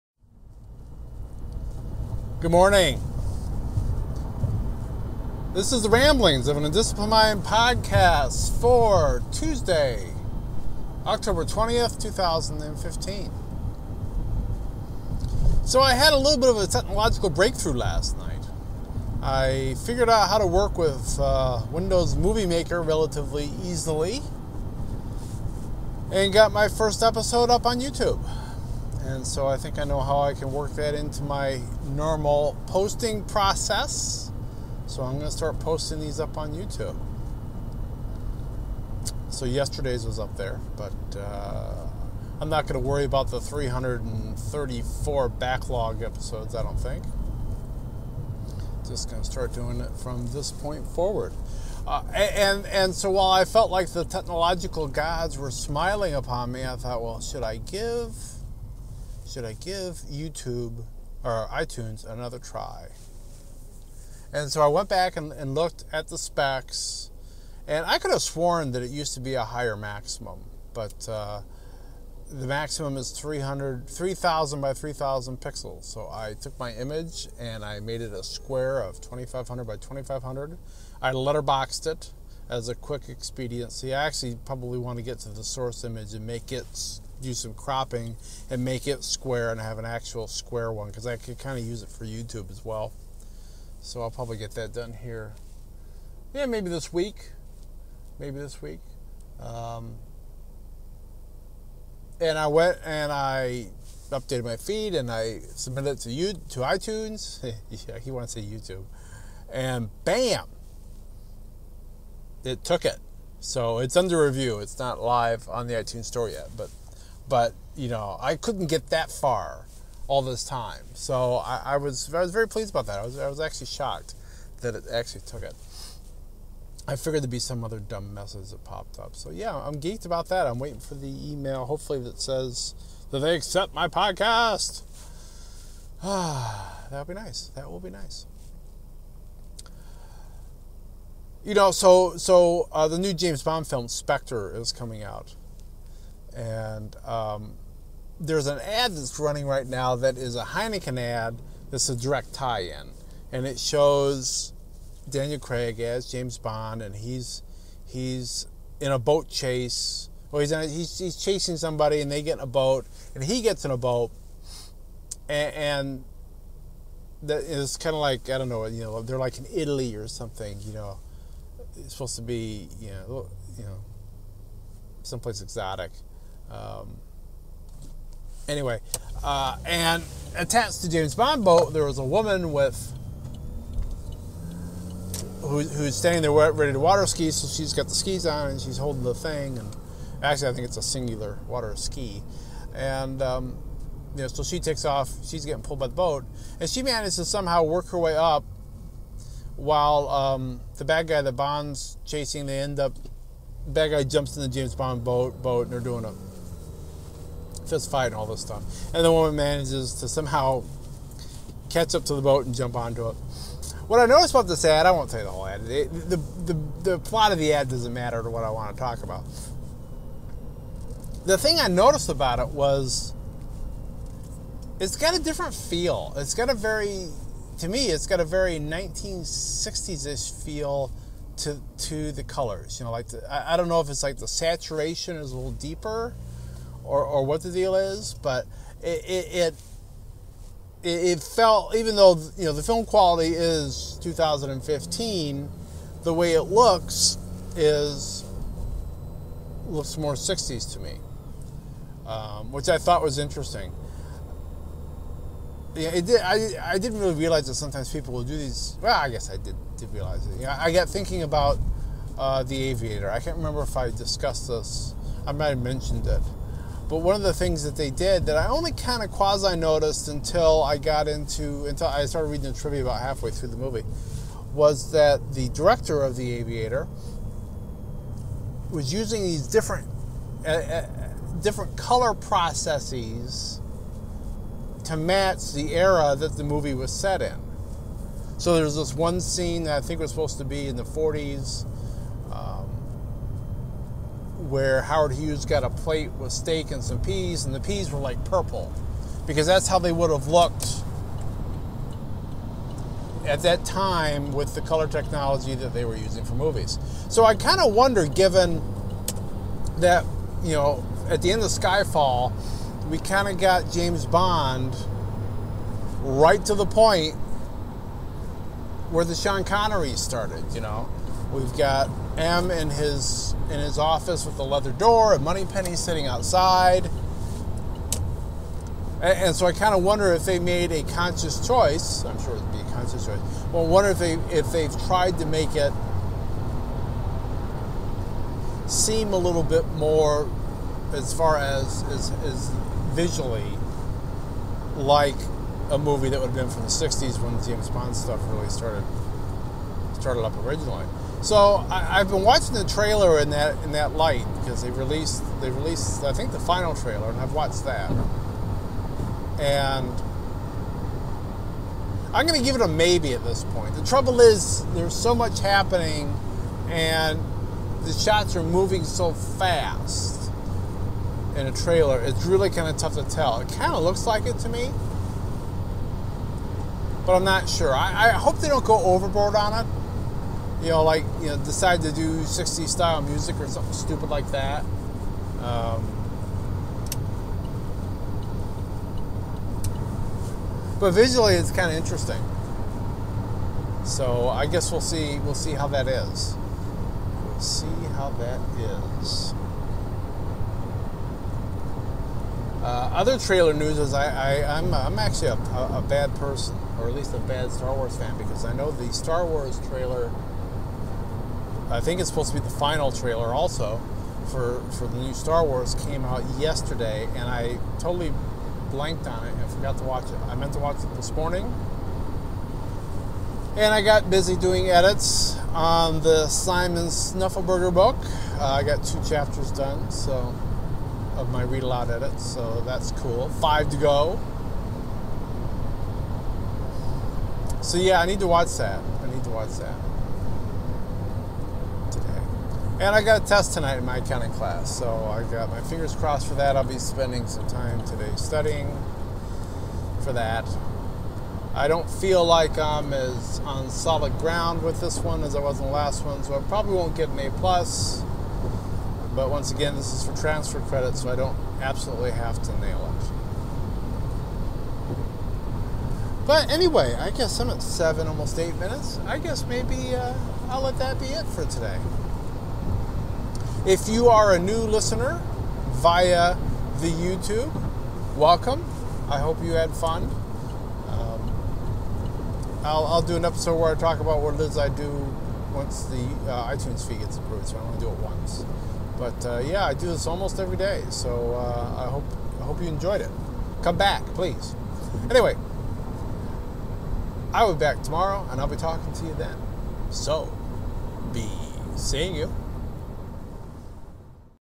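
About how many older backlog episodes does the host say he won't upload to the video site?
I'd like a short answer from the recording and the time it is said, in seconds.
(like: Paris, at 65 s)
334, at 43 s.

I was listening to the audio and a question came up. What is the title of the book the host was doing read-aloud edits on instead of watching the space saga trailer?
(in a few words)
Simon Snuffleburger.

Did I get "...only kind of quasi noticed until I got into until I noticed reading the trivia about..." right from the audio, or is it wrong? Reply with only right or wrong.
wrong.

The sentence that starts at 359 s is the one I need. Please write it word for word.
And I'm going to give it a maybe at this point.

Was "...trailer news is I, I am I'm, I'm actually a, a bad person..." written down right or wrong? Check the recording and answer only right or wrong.
right.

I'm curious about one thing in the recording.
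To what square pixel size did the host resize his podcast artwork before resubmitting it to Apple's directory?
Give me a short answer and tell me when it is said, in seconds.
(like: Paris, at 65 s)
2,500 by 2,500, at 78 s.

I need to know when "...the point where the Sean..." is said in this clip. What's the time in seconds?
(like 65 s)
316 s.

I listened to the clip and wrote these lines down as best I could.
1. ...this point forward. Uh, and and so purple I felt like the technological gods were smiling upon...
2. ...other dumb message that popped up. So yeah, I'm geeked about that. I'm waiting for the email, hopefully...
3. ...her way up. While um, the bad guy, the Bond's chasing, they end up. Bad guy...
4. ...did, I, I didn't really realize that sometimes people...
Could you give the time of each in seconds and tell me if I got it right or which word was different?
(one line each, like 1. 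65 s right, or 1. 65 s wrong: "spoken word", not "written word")
1. 50 s wrong: "while", not "purple"
2. 127 s right
3. 197 s right
4. 256 s right.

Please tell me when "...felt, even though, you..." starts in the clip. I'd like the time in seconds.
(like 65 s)
241 s.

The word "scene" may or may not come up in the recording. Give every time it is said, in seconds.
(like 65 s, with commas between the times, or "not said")
289 s.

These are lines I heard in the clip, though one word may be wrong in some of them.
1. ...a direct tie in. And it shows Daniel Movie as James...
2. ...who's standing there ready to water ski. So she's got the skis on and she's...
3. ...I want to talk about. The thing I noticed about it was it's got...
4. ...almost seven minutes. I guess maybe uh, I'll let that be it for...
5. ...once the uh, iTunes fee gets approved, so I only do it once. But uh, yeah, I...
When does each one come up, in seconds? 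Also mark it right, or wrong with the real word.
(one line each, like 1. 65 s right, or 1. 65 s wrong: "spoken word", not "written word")
1. 151 s wrong: "Craig", not "Movie"
2. 185 s right
3. 218 s right
4. 468 s wrong: "eight", not "seven"
5. 485 s right.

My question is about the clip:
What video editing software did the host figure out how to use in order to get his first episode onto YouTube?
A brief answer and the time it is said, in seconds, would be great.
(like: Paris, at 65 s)
Windows Movie Maker, at 21 s.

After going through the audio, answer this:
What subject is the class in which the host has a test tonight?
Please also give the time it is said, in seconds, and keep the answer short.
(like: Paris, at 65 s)
accounting, at 443 s.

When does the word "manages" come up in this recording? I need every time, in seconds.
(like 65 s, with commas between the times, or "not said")
196 s, 209 s.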